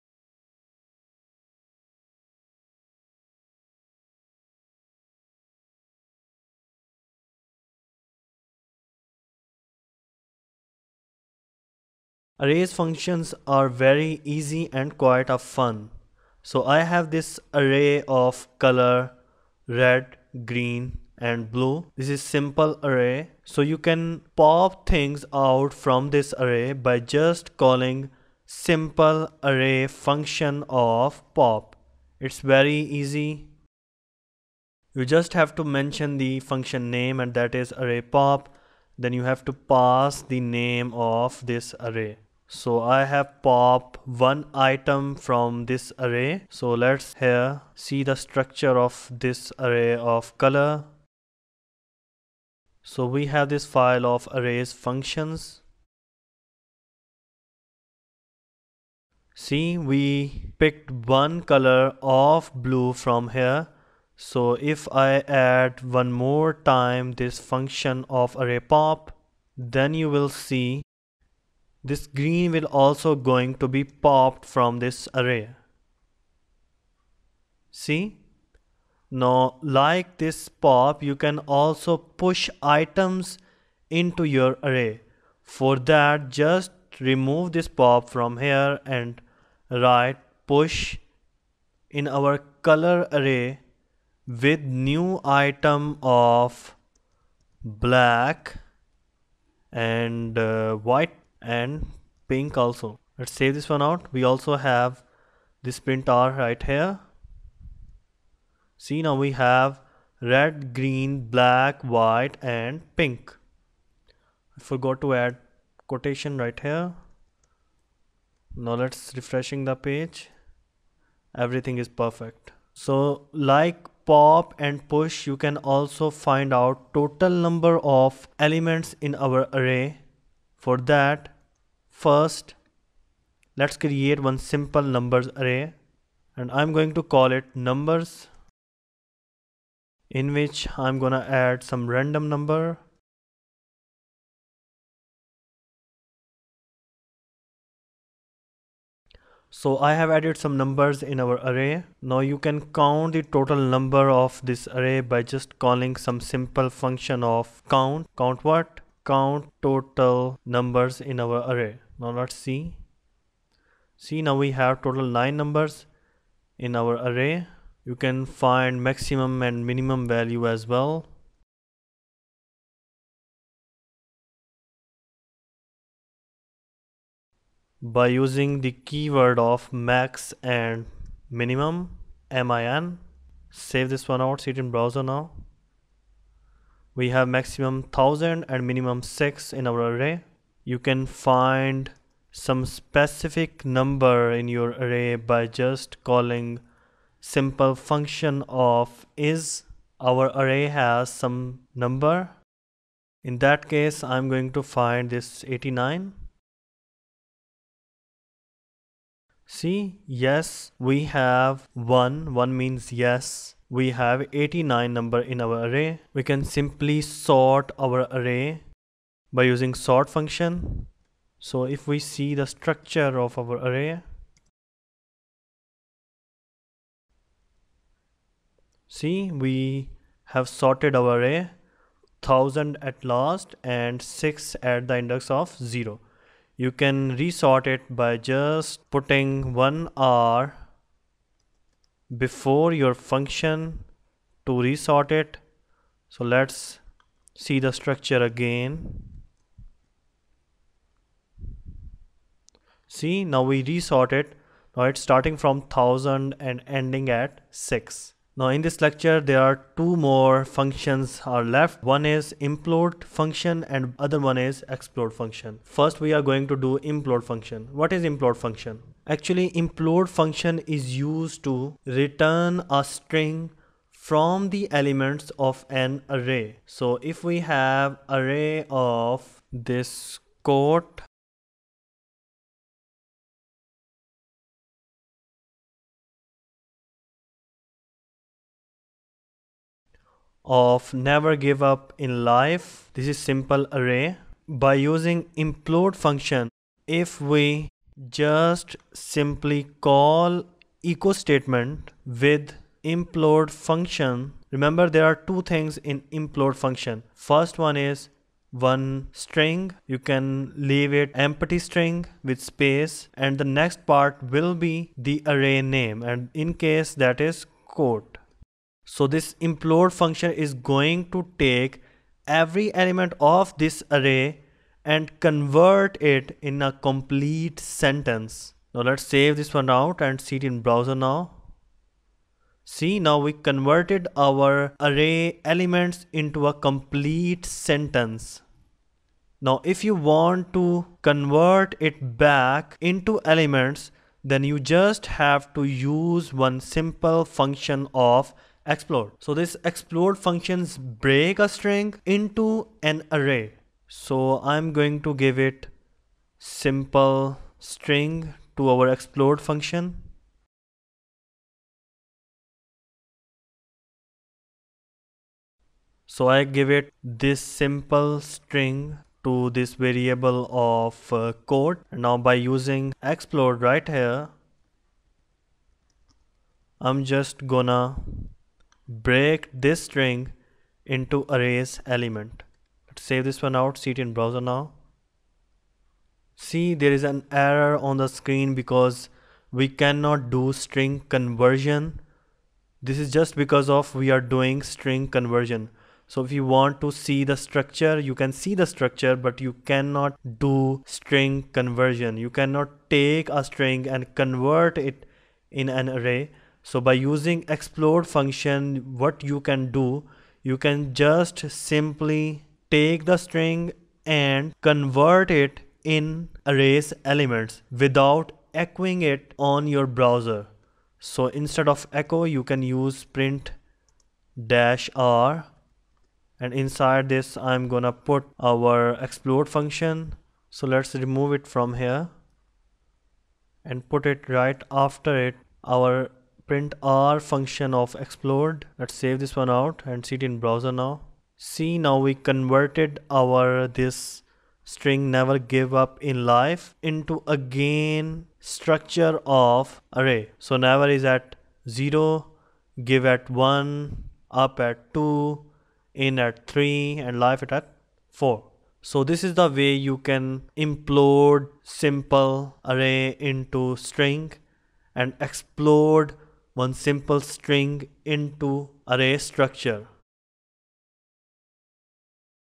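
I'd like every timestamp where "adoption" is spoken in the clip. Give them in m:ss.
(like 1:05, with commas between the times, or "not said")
not said.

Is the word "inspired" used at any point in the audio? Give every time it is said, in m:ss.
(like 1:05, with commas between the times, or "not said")
not said.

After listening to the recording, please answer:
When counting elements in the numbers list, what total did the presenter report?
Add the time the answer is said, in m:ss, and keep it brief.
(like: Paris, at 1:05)
9, at 2:45.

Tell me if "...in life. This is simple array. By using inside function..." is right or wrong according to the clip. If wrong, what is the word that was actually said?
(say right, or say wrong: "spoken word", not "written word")
wrong: "implode", not "inside".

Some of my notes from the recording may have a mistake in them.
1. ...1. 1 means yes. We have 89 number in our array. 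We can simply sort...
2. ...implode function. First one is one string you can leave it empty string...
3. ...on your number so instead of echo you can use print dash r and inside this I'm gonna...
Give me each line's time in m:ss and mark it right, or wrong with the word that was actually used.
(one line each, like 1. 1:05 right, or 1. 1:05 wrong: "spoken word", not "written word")
1. 3:31 right
2. 5:06 right
3. 6:59 wrong: "browser", not "number".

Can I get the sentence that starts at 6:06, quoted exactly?
So I give it this simple string to this variable of uh, quote.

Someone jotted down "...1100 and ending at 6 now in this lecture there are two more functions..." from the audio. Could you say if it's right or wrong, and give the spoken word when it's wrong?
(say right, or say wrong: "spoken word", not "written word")
wrong: "1000", not "1100".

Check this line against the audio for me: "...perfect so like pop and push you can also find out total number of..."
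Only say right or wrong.
right.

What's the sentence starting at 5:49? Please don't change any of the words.
So this explode functions break a string into an array.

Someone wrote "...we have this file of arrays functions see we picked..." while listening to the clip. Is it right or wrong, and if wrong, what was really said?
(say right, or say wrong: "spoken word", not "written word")
right.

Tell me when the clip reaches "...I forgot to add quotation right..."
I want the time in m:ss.
1:54.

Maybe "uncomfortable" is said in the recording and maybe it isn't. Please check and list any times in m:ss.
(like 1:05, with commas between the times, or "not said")
not said.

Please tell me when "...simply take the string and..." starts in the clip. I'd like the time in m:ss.
6:51.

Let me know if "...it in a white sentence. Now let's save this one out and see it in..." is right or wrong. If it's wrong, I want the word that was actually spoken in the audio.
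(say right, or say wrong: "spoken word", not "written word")
wrong: "complete", not "white".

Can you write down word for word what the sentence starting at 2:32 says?
Now you can count the total number of this array by just calling some simple function of count.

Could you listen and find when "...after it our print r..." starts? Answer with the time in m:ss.
7:14.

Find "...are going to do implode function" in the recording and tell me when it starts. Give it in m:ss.
4:26.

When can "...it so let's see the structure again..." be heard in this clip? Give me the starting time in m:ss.
4:05.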